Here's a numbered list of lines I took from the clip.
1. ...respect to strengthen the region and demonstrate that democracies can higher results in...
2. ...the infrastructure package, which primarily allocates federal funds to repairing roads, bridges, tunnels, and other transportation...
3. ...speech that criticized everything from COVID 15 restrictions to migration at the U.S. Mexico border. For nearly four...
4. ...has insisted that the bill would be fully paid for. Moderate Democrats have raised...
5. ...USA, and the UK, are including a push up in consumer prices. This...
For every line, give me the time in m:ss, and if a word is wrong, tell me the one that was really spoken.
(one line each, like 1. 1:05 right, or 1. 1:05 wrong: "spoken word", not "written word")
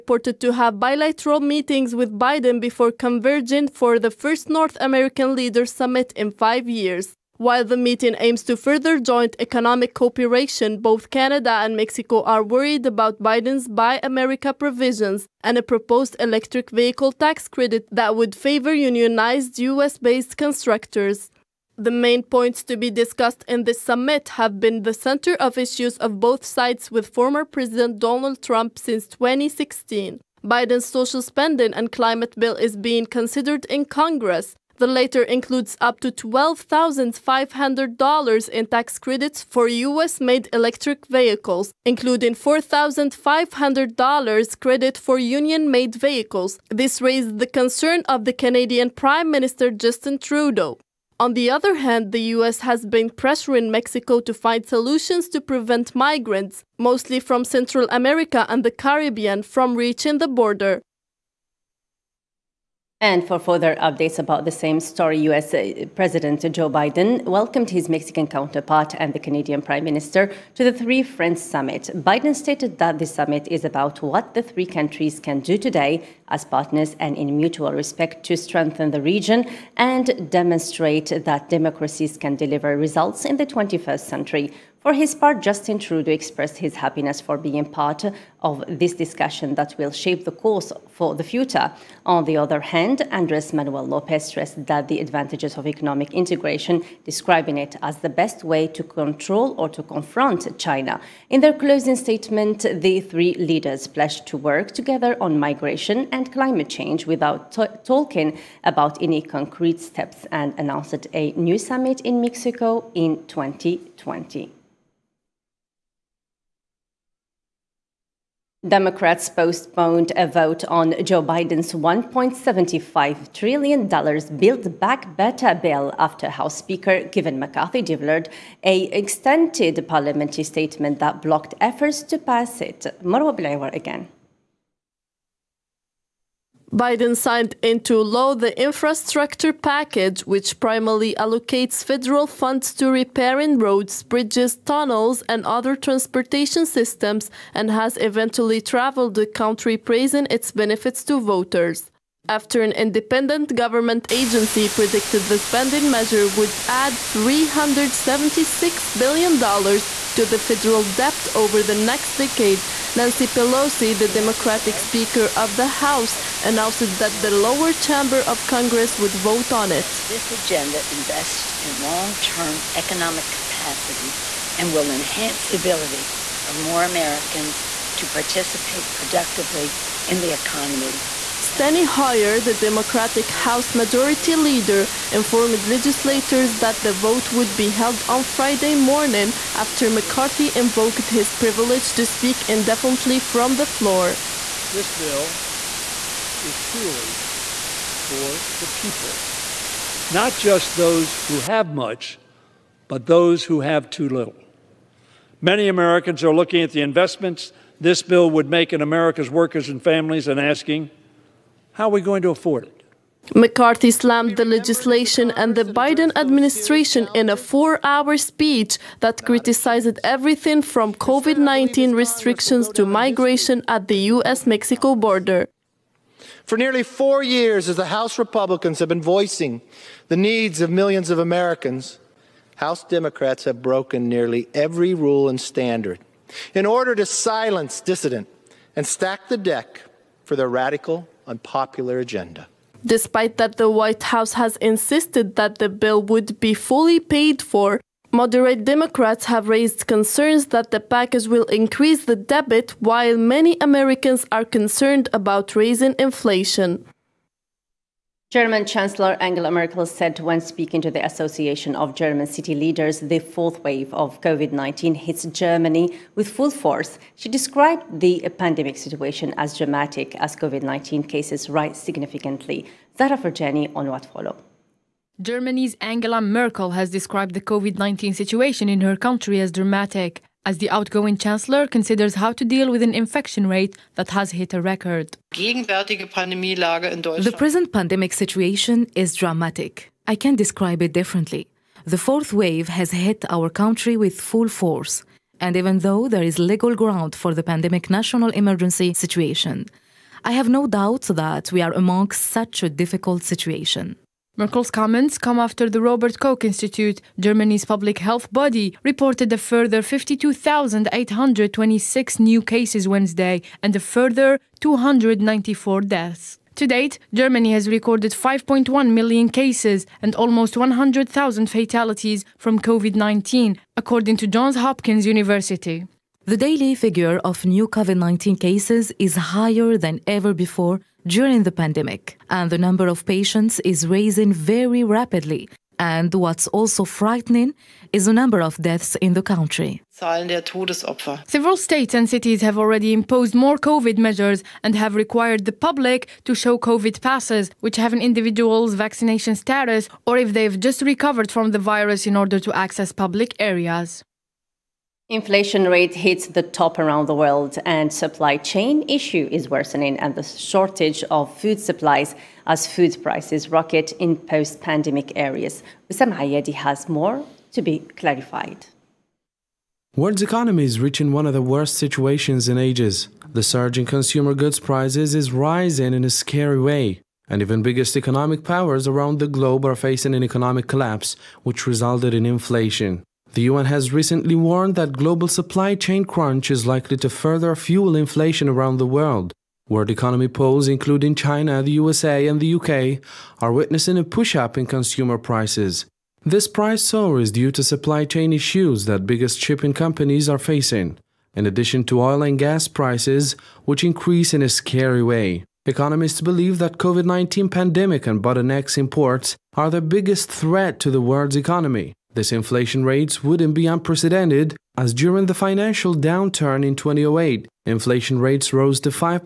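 1. 1:17 wrong: "deliver", not "higher"
2. 2:18 right
3. 3:38 wrong: "19", not "15"
4. 4:04 right
5. 6:31 wrong: "witnessing", not "including".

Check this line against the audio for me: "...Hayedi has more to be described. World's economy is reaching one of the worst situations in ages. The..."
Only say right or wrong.
wrong.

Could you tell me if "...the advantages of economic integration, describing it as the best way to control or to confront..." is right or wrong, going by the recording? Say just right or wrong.
right.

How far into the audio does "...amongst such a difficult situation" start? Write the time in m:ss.
5:01.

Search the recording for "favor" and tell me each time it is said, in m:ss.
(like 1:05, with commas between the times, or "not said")
0:18.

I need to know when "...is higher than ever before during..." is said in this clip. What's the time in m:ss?
5:29.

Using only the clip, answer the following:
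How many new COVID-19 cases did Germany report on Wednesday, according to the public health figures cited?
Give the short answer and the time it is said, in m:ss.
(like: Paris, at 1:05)
52,826, at 5:09.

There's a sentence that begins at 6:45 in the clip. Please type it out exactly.
Economists believe that COVID-19 pandemic and bottlenecks imports are the biggest threat to the world's economy.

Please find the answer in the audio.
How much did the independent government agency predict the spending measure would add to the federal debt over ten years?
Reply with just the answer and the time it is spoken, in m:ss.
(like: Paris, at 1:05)
$376 billion, at 2:37.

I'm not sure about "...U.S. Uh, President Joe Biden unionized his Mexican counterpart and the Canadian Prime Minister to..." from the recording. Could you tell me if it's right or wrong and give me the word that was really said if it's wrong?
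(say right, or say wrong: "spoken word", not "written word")
wrong: "welcomed", not "unionized".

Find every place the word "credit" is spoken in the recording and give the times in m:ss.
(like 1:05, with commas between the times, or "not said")
0:17, 0:39, 0:44.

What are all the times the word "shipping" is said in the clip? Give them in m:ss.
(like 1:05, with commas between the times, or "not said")
6:39.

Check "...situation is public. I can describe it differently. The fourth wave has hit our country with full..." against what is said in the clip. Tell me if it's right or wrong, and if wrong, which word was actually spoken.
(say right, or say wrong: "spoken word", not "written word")
wrong: "dramatic", not "public".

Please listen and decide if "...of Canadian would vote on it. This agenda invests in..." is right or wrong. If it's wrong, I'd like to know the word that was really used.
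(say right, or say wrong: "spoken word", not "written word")
wrong: "Congress", not "Canadian".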